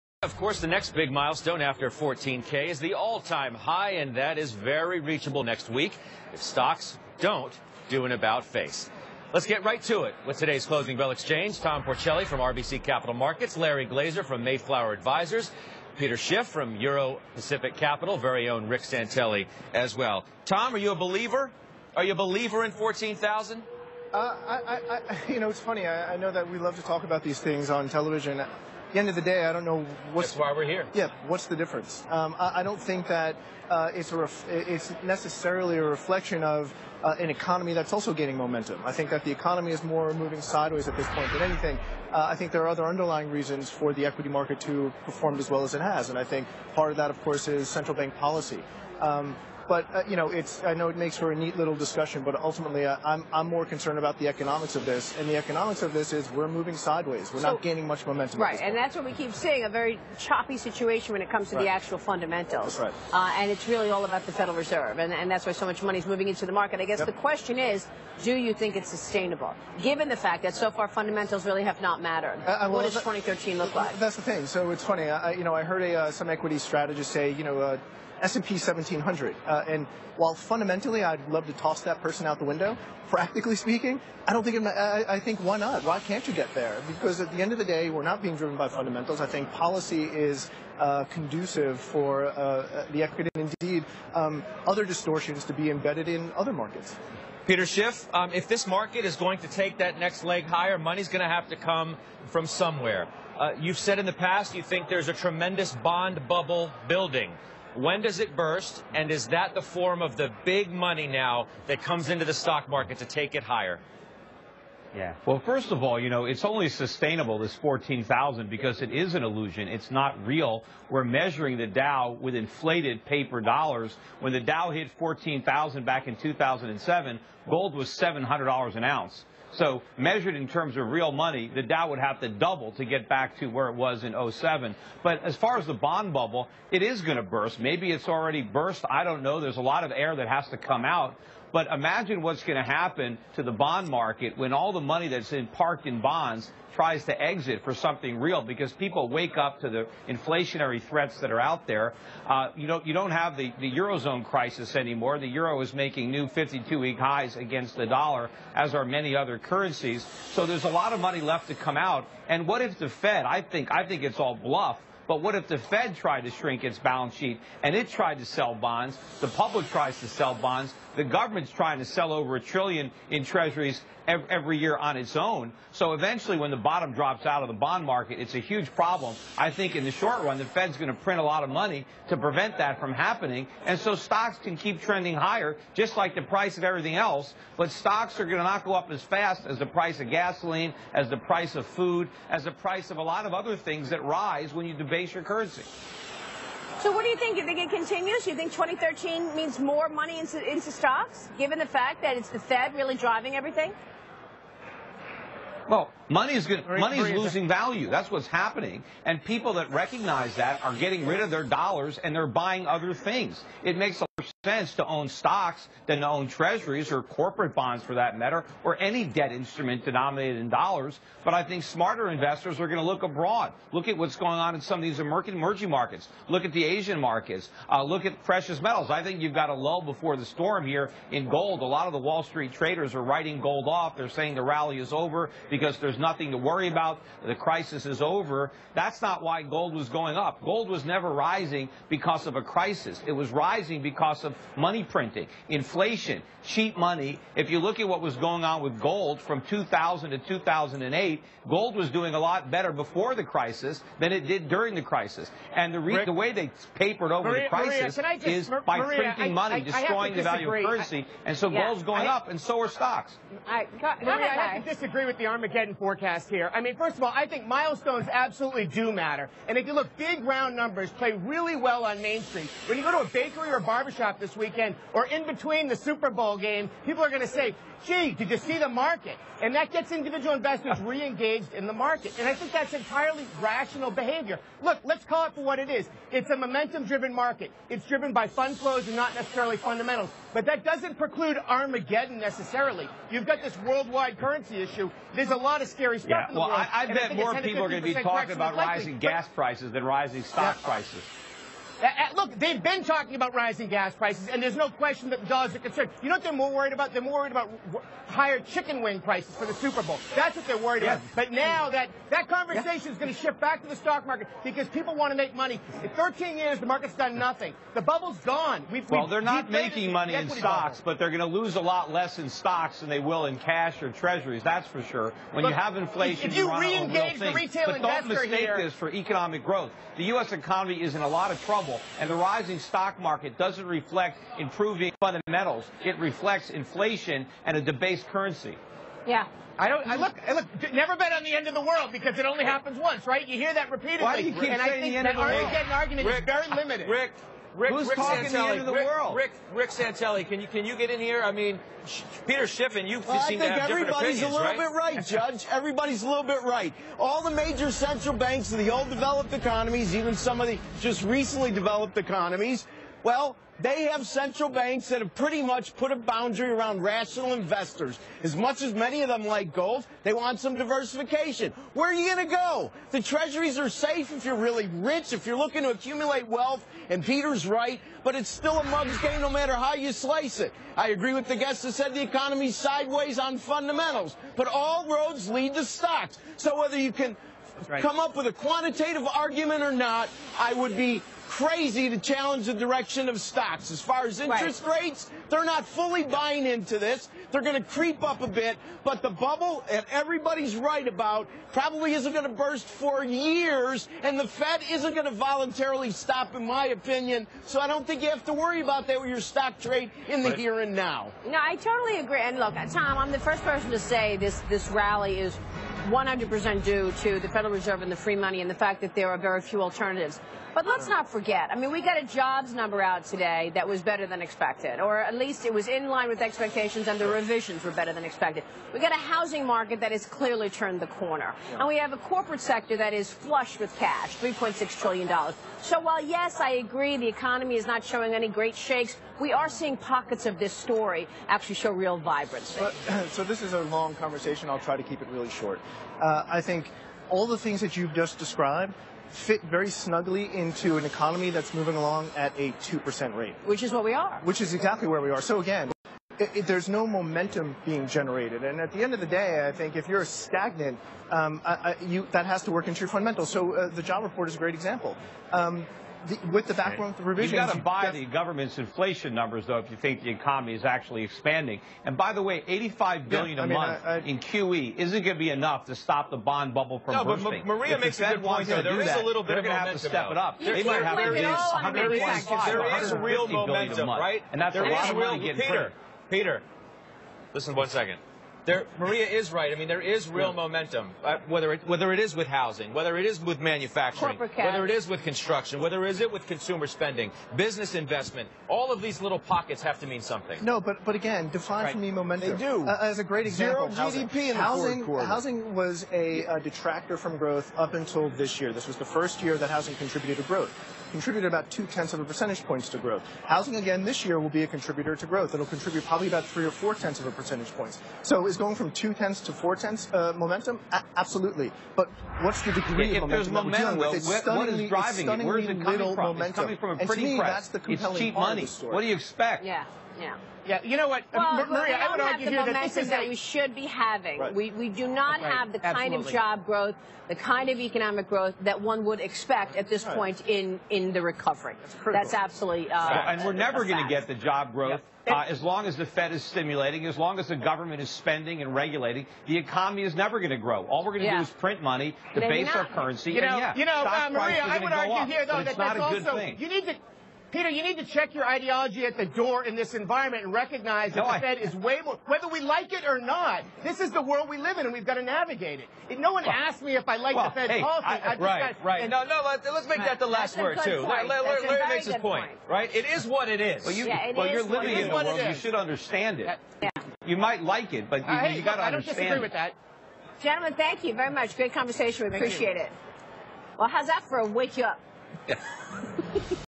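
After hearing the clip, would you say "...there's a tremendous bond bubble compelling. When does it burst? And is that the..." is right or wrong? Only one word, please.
wrong.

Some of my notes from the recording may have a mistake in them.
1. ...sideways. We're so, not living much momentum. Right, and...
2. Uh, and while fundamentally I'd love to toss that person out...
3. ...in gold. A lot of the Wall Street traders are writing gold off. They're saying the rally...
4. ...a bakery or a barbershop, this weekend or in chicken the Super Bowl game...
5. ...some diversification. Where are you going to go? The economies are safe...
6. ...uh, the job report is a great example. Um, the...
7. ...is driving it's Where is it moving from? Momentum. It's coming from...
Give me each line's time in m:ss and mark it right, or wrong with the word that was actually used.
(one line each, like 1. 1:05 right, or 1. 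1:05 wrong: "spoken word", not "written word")
1. 0:56 wrong: "gaining", not "living"
2. 1:19 right
3. 3:51 right
4. 4:32 wrong: "between", not "chicken"
5. 6:10 wrong: "treasuries", not "economies"
6. 7:43 right
7. 8:44 wrong: "coming", not "moving".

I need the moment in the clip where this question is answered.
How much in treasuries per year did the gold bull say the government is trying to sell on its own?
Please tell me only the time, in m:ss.
2:52.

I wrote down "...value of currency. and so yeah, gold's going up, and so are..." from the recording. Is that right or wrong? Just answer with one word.
right.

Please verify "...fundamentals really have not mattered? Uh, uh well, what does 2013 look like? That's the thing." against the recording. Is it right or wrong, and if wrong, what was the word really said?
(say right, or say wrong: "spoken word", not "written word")
right.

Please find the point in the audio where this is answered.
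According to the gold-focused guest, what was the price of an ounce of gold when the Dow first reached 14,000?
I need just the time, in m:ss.
2:07.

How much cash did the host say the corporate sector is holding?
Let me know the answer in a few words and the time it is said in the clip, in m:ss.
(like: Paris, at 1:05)
$3.6 trillion, at 7:14.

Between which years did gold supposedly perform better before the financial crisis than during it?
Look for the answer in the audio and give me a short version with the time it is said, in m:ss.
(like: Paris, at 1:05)
2000 to 2008, at 4:09.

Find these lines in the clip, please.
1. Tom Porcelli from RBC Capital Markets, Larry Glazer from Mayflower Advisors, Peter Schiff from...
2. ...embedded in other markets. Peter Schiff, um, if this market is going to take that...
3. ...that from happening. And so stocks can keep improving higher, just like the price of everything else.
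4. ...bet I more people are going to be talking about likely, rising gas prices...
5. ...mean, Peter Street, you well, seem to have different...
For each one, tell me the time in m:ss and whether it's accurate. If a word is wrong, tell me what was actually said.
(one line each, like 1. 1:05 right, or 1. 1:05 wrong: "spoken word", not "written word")
1. 0:11 right
2. 1:35 right
3. 3:02 wrong: "trending", not "improving"
4. 4:56 right
5. 5:51 wrong: "Schiffin", not "Street".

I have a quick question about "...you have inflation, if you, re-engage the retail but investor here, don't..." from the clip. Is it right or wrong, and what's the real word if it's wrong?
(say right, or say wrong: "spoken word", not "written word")
right.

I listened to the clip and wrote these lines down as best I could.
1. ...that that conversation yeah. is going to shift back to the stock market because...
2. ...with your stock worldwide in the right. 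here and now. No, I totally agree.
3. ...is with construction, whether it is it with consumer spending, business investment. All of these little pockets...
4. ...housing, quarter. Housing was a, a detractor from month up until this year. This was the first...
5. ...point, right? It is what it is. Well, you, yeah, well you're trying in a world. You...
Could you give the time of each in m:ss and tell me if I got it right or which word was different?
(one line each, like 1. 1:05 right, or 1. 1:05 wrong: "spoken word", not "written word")
1. 5:11 right
2. 6:48 wrong: "trade", not "worldwide"
3. 8:14 right
4. 8:24 wrong: "growth", not "month"
5. 9:32 wrong: "living", not "trying".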